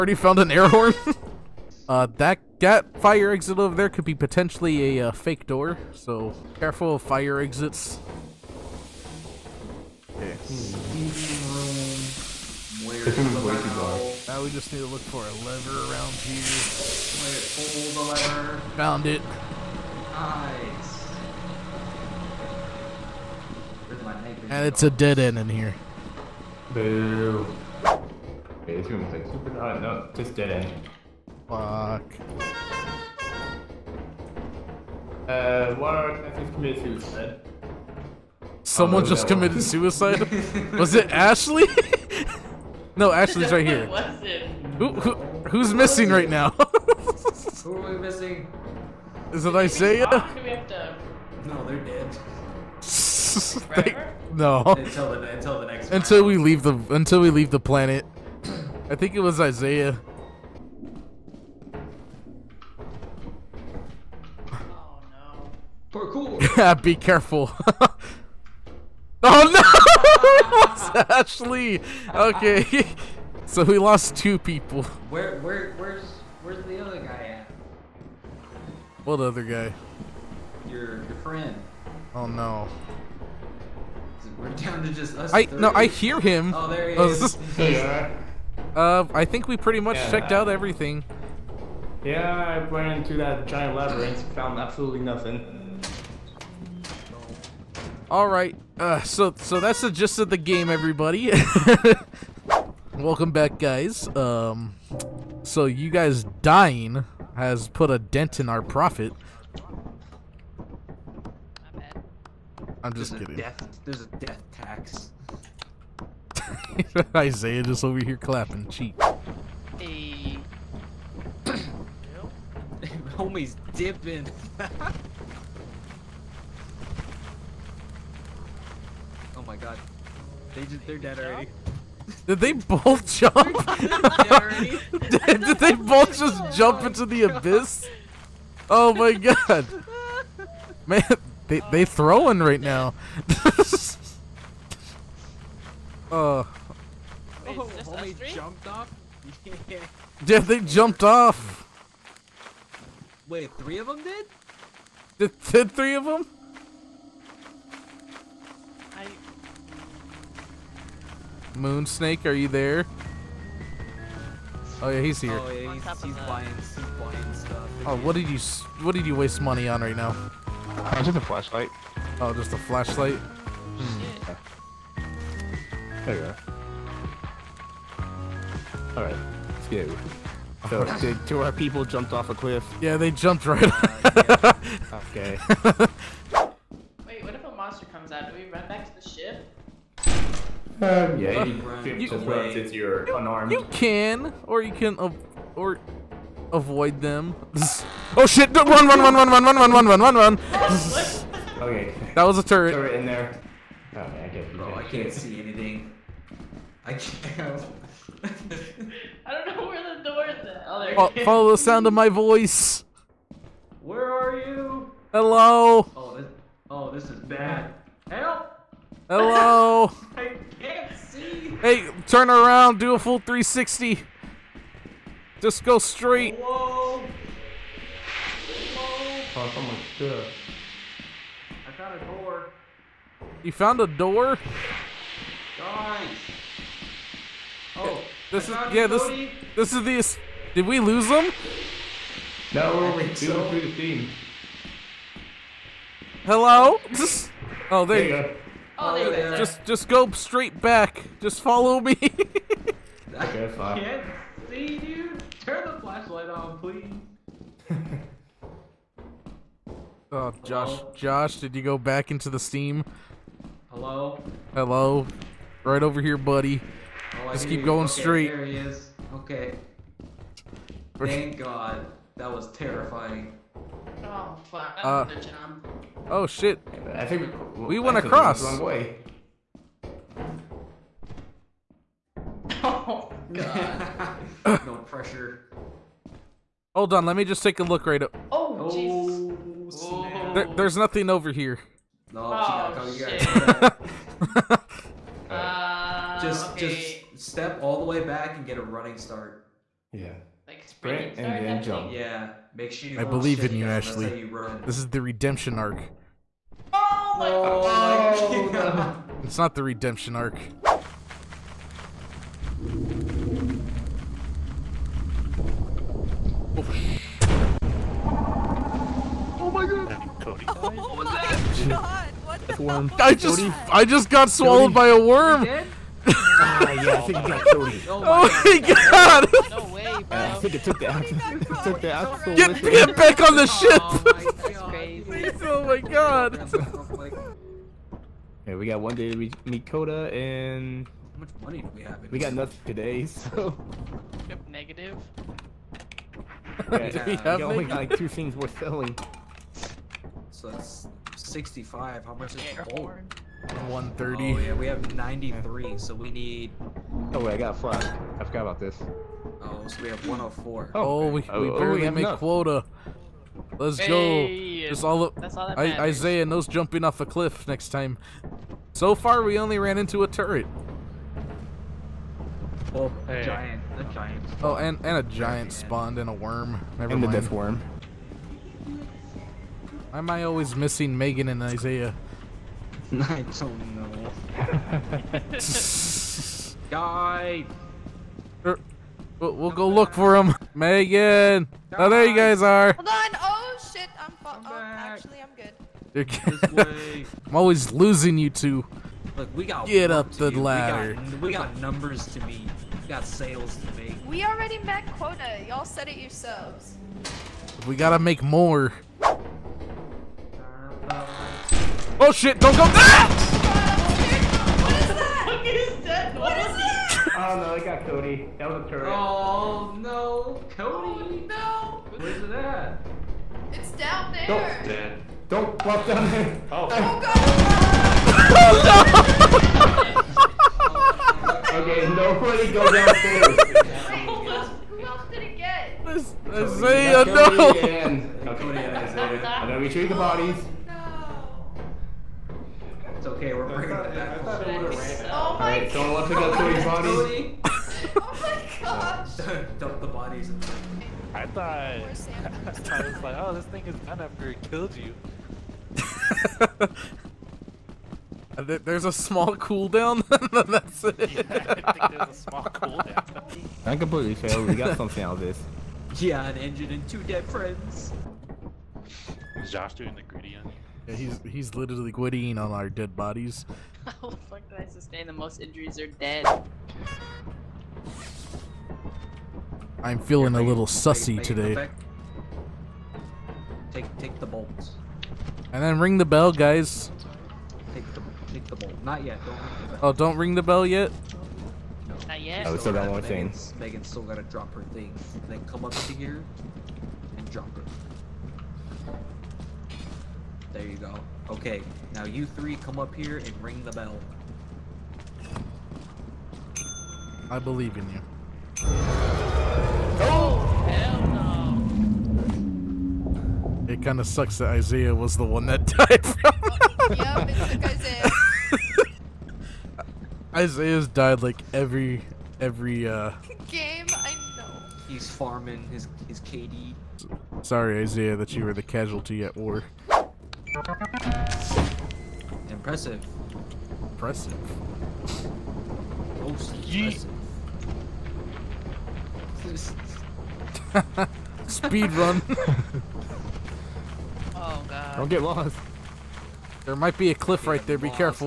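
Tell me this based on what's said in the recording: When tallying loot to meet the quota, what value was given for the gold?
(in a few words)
130.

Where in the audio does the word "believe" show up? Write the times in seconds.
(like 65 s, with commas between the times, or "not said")
303 s, 507 s.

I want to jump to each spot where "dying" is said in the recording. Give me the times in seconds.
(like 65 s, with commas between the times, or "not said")
106 s.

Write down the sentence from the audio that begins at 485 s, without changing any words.
And then ring the bell, guys.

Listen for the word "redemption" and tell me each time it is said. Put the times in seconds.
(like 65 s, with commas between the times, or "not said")
305 s, 309 s.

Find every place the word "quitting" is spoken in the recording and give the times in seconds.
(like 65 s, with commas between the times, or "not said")
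471 s.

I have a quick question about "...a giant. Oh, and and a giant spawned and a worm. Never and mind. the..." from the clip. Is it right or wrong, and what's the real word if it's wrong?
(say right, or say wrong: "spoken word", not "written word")
right.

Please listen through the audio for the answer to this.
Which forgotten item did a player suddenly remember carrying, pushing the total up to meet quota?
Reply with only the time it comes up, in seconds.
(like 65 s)
357 s.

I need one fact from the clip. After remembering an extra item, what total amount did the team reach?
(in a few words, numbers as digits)
104.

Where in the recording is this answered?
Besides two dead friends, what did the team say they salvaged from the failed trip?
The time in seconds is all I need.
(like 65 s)
466 s.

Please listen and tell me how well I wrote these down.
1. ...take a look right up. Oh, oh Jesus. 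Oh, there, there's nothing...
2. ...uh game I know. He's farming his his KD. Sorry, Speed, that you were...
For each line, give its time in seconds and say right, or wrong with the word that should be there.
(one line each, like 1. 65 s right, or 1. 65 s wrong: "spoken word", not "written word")
1. 287 s right
2. 522 s wrong: "Isaiah", not "Speed".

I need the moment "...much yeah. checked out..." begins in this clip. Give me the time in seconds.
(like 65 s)
89 s.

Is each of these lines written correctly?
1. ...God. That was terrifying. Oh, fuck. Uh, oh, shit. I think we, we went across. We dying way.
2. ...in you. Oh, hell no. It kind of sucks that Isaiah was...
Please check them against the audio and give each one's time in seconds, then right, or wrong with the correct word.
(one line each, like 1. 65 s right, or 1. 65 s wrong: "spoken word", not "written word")
1. 271 s wrong: "wrong", not "dying"
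2. 507 s right.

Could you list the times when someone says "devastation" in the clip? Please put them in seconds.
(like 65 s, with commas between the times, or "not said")
not said.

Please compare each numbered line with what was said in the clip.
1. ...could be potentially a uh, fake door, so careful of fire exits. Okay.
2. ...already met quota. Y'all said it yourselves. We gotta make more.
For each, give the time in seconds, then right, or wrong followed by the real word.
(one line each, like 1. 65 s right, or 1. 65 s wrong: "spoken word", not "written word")
1. 3 s right
2. 404 s right.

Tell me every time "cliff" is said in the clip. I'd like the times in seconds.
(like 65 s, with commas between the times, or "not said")
182 s, 367 s, 547 s.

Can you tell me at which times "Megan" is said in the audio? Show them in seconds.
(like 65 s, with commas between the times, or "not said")
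380 s, 390 s, 493 s.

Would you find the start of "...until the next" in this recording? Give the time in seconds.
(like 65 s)
55 s.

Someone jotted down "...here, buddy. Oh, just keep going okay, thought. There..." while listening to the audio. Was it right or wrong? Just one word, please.
wrong.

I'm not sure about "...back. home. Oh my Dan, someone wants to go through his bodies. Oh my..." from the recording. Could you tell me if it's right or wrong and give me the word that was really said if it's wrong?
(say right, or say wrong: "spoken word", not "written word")
wrong: "Alright", not "Dan".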